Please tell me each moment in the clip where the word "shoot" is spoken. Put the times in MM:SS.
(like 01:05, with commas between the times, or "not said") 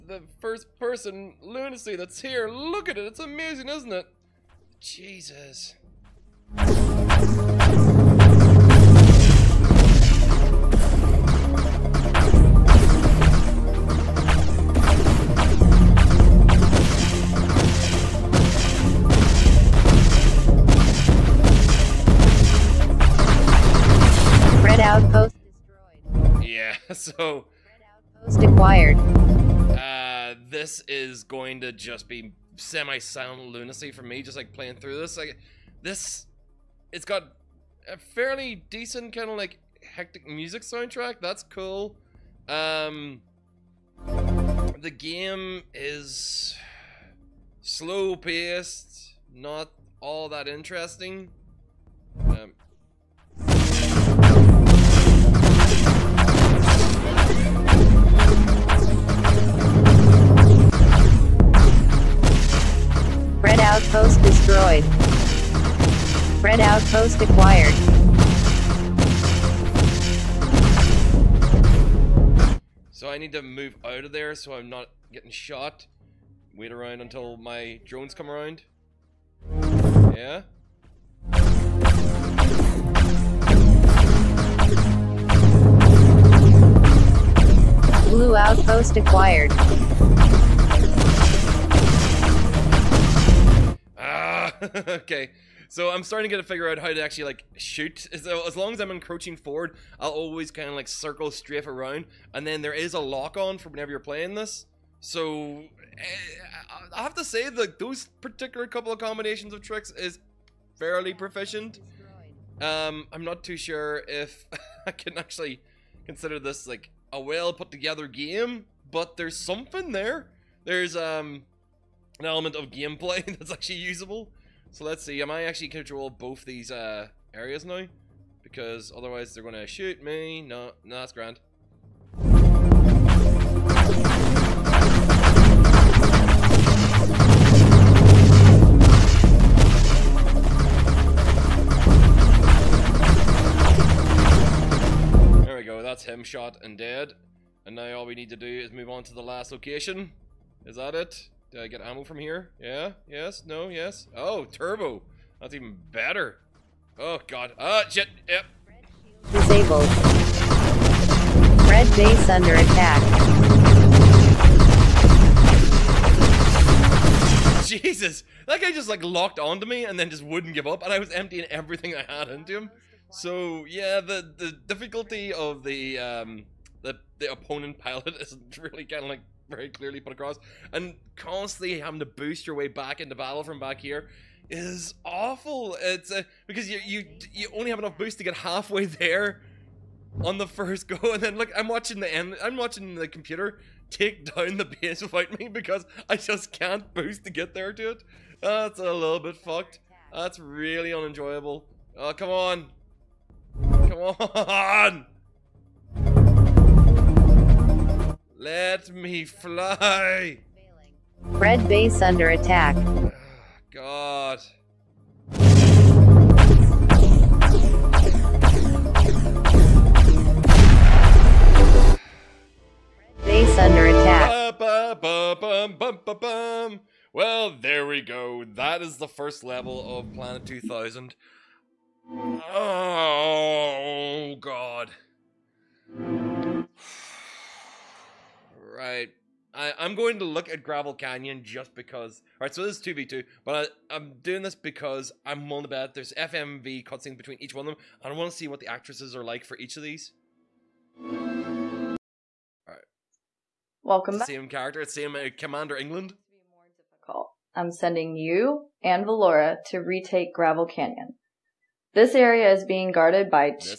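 01:37, 02:09.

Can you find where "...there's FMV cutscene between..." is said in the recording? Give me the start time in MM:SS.
04:05.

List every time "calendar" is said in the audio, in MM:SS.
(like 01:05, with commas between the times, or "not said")
not said.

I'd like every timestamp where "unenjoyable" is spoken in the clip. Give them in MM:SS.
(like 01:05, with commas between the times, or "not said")
03:20.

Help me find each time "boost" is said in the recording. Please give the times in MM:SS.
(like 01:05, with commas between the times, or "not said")
03:02, 03:07, 03:16.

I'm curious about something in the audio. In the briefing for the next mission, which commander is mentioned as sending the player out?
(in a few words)
Commander England.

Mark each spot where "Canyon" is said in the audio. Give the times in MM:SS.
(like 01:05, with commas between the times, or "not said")
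04:00, 04:20.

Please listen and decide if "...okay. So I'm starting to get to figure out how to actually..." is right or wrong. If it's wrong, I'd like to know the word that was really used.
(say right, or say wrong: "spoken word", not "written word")
right.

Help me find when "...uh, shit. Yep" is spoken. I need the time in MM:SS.
02:37.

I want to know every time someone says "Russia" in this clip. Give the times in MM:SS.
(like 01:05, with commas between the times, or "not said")
not said.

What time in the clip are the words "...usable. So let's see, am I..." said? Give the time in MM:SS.
02:03.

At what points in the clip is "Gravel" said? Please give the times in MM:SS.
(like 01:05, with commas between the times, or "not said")
04:00, 04:20.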